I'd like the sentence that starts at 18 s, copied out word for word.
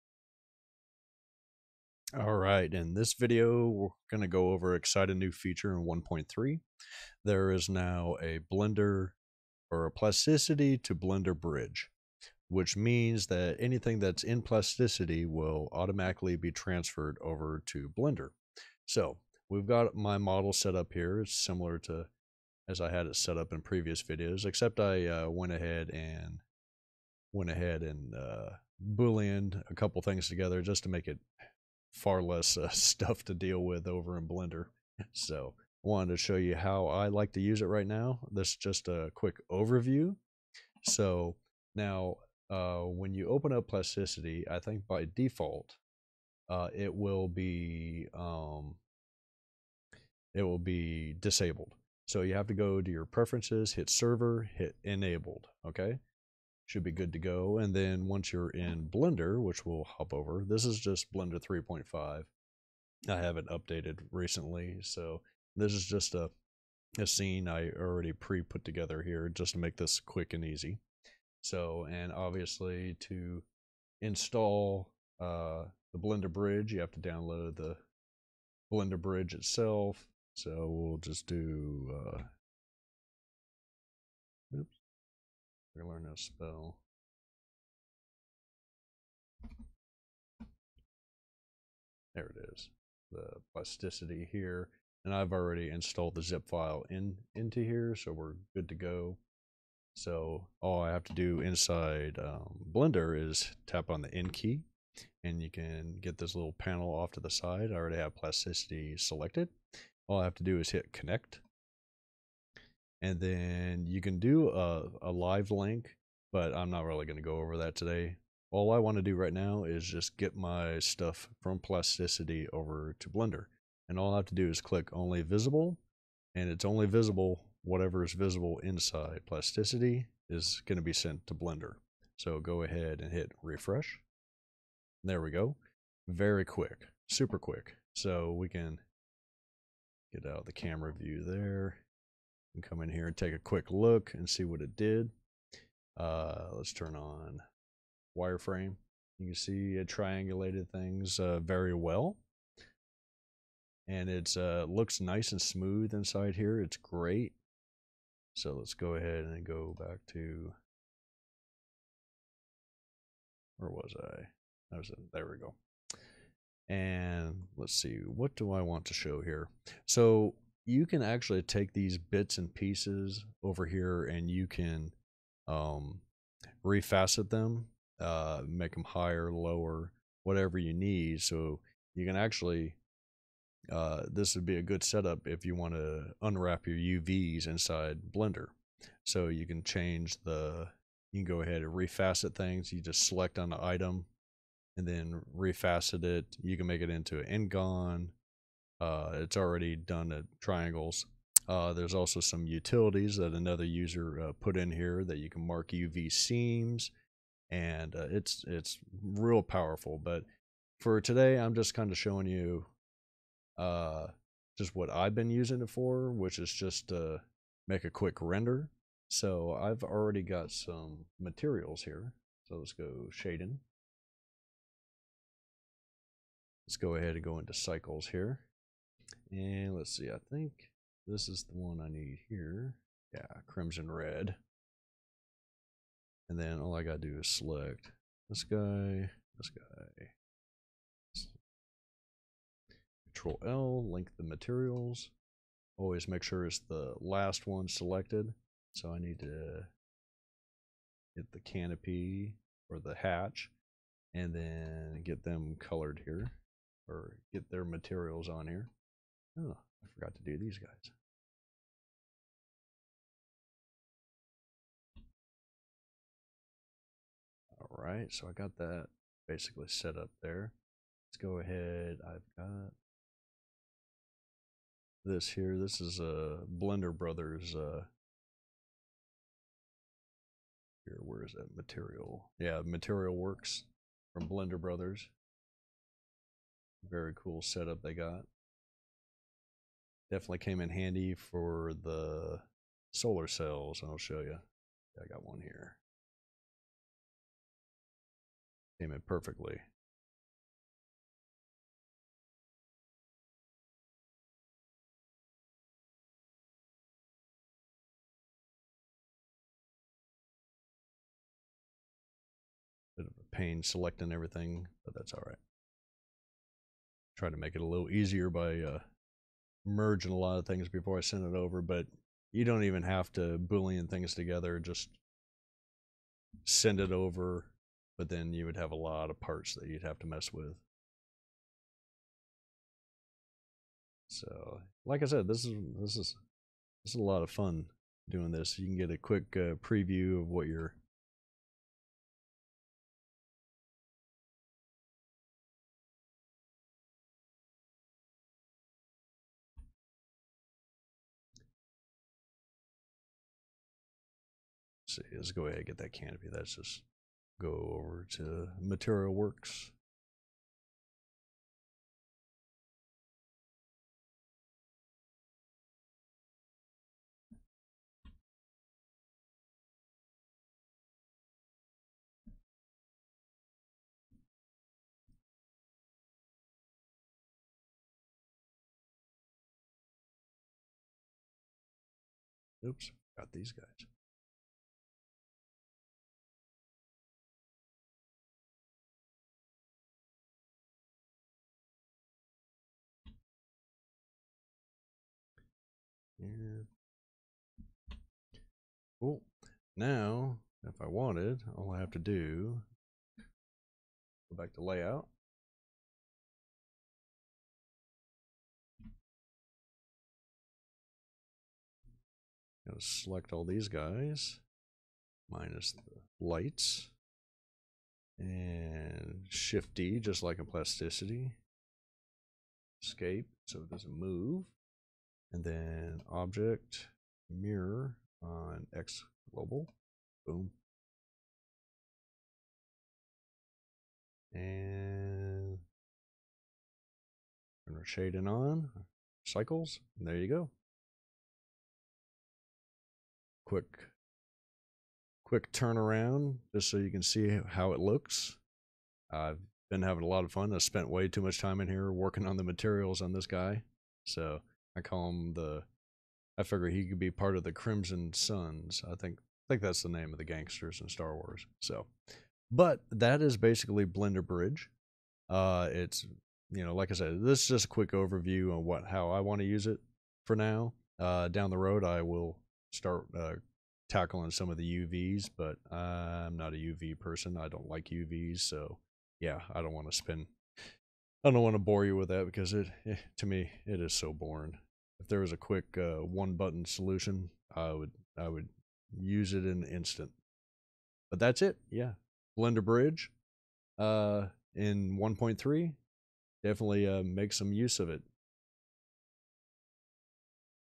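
So we've got my model set up here.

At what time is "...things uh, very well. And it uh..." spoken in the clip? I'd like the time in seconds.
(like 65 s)
150 s.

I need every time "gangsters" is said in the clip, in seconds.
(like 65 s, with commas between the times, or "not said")
460 s.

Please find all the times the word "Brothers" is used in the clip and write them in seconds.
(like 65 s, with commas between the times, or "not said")
276 s, 284 s.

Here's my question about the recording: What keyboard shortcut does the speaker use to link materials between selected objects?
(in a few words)
Control L.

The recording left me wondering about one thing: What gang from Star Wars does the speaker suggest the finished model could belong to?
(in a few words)
Crimson Suns.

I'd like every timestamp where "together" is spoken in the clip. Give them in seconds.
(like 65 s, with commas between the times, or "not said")
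30 s, 68 s, 324 s.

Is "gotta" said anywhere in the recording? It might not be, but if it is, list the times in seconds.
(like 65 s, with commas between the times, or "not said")
236 s, 412 s.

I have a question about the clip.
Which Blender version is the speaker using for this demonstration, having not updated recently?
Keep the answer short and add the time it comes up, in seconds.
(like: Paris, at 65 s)
3.5, at 61 s.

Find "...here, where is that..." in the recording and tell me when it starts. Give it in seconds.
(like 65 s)
280 s.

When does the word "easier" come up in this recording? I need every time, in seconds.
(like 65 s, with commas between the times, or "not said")
317 s.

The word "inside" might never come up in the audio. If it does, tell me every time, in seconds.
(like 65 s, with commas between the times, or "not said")
101 s, 128 s, 155 s, 187 s.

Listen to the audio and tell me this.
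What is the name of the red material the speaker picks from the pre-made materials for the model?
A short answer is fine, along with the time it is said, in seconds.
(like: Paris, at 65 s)
Crimson red, at 233 s.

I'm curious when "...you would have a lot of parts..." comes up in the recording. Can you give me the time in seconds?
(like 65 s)
328 s.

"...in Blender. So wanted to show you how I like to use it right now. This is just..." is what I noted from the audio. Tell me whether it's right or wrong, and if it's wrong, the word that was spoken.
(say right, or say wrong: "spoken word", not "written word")
right.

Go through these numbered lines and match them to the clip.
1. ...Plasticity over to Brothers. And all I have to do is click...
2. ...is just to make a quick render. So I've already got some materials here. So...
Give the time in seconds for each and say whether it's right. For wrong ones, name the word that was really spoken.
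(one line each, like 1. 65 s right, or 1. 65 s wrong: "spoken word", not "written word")
1. 121 s wrong: "Blender", not "Brothers"
2. 216 s right.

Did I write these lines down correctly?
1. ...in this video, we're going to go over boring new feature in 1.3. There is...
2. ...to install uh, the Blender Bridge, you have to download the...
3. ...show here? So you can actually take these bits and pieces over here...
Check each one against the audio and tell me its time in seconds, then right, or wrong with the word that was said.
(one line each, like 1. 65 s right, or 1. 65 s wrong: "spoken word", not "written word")
1. 2 s wrong: "exciting", not "boring"
2. 73 s right
3. 168 s right.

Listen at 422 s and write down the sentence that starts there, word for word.
Escape, so it doesn't move and then object mirror on X global.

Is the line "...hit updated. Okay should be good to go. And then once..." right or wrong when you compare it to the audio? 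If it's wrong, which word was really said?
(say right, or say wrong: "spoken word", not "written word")
wrong: "enabled", not "updated".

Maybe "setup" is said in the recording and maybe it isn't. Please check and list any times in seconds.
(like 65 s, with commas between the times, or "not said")
184 s, 287 s.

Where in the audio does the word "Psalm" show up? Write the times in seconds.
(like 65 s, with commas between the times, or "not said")
not said.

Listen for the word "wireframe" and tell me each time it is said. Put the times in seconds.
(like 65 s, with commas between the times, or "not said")
148 s.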